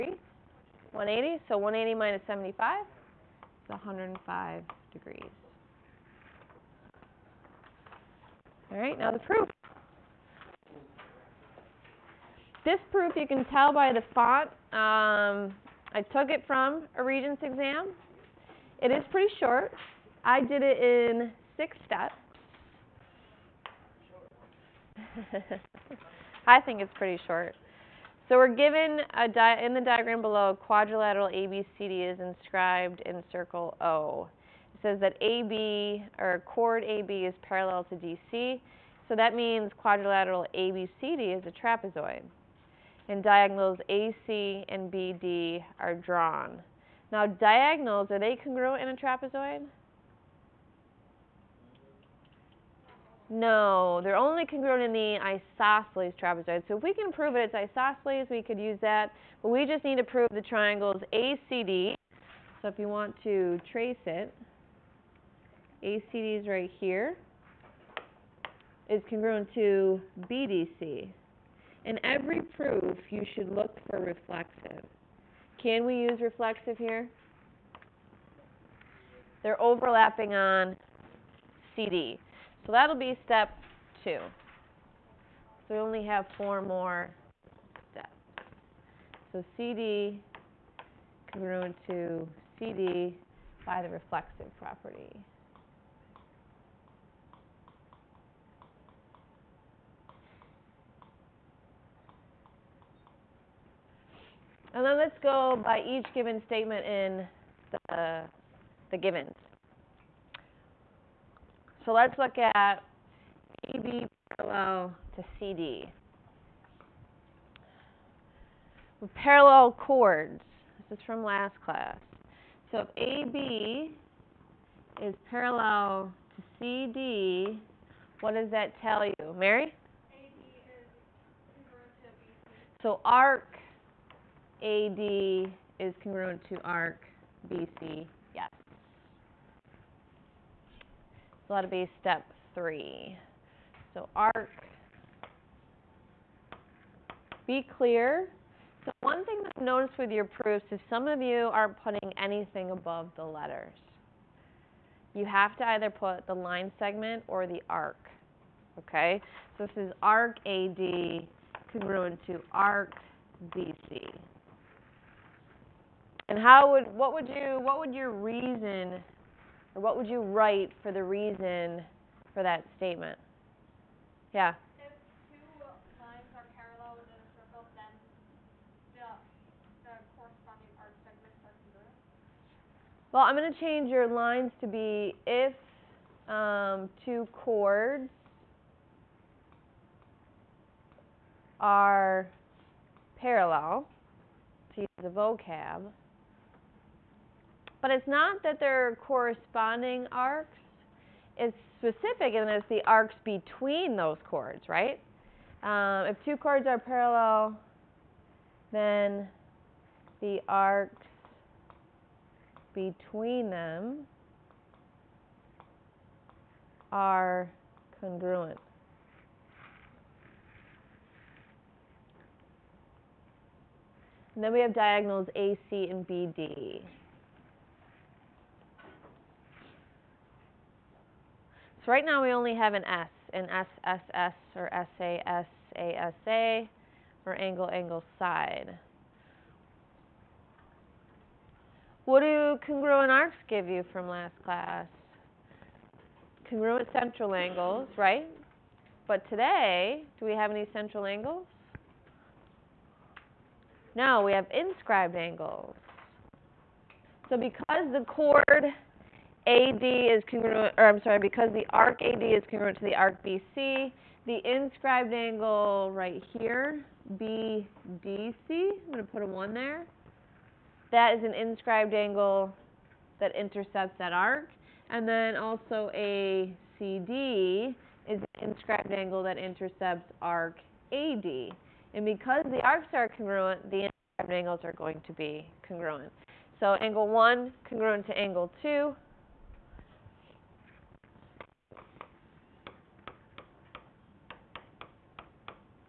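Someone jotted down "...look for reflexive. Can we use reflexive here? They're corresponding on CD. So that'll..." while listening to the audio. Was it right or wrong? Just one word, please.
wrong.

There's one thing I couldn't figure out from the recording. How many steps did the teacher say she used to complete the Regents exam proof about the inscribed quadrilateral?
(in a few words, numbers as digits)
6.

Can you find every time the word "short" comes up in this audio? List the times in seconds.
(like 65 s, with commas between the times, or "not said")
19 s, 27 s.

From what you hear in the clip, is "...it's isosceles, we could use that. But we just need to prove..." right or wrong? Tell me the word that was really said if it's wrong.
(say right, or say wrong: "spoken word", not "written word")
right.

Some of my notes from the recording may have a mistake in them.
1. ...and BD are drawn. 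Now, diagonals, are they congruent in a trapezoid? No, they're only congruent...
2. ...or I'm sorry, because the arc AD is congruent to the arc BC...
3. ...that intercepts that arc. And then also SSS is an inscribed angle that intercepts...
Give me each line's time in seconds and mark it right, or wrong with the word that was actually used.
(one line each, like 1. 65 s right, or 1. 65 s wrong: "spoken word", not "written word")
1. 44 s right
2. 260 s right
3. 273 s wrong: "ACD", not "SSS".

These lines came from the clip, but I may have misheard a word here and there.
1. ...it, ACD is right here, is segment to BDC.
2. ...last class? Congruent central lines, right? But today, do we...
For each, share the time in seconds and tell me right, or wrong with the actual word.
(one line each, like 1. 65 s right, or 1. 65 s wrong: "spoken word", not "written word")
1. 64 s wrong: "congruent", not "segment"
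2. 244 s wrong: "angles", not "lines".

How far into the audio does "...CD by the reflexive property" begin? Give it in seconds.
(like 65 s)
92 s.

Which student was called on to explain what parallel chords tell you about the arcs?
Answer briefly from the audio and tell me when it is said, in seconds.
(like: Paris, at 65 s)
Mary, at 129 s.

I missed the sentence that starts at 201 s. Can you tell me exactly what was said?
It's specific and it's the arcs between those chords, right?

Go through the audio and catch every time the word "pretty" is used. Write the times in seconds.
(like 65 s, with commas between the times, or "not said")
19 s, 26 s.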